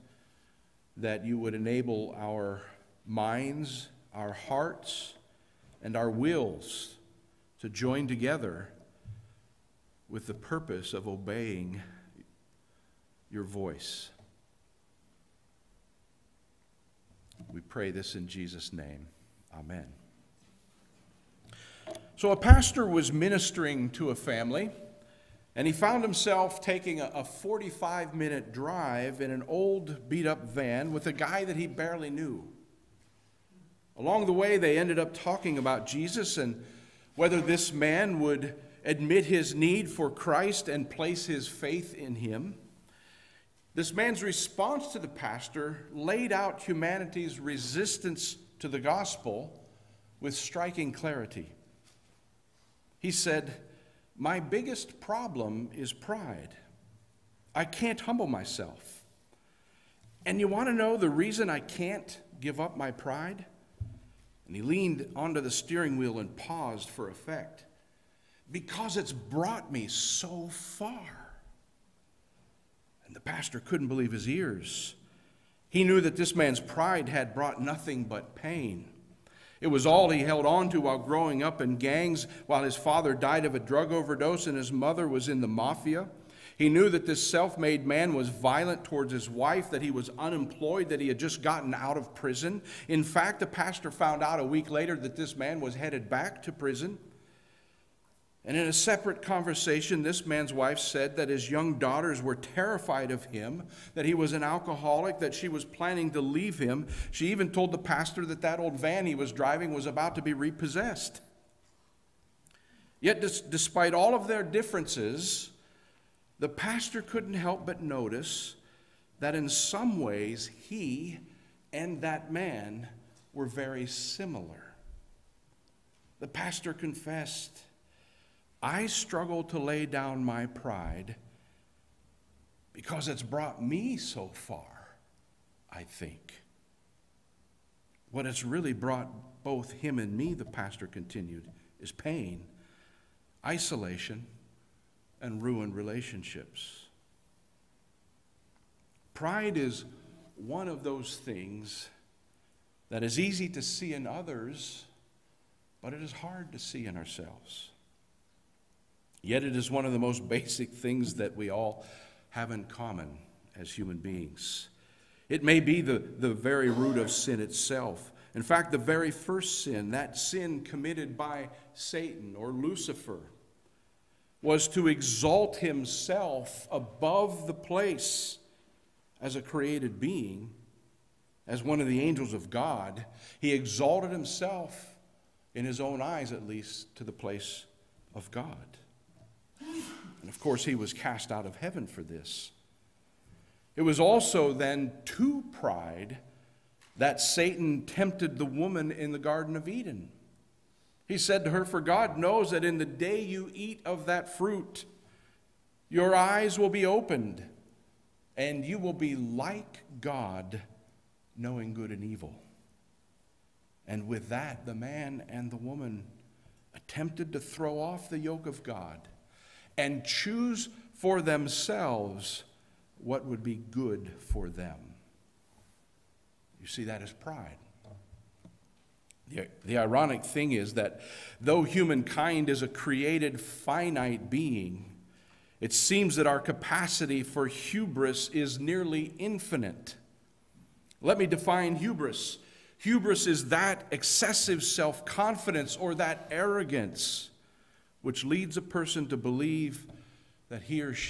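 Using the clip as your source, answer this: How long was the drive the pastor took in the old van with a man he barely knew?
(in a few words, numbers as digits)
45 minutes.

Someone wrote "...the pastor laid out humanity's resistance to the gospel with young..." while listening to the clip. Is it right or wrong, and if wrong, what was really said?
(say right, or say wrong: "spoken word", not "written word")
wrong: "striking", not "young".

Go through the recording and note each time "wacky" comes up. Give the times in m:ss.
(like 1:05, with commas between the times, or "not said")
not said.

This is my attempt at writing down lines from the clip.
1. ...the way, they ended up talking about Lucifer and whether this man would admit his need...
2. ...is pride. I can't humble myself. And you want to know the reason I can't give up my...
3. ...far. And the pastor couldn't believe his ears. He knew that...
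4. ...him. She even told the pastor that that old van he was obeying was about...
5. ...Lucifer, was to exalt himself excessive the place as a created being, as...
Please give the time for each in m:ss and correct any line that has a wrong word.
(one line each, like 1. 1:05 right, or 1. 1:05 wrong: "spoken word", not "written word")
1. 0:34 wrong: "Jesus", not "Lucifer"
2. 0:55 right
3. 1:10 right
4. 1:46 wrong: "driving", not "obeying"
5. 2:52 wrong: "above", not "excessive".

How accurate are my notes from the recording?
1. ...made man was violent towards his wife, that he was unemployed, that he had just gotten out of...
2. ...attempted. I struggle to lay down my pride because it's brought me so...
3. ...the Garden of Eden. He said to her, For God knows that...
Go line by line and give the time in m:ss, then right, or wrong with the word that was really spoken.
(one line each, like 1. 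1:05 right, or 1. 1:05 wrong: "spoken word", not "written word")
1. 1:27 right
2. 2:06 wrong: "confessed", not "attempted"
3. 3:19 right.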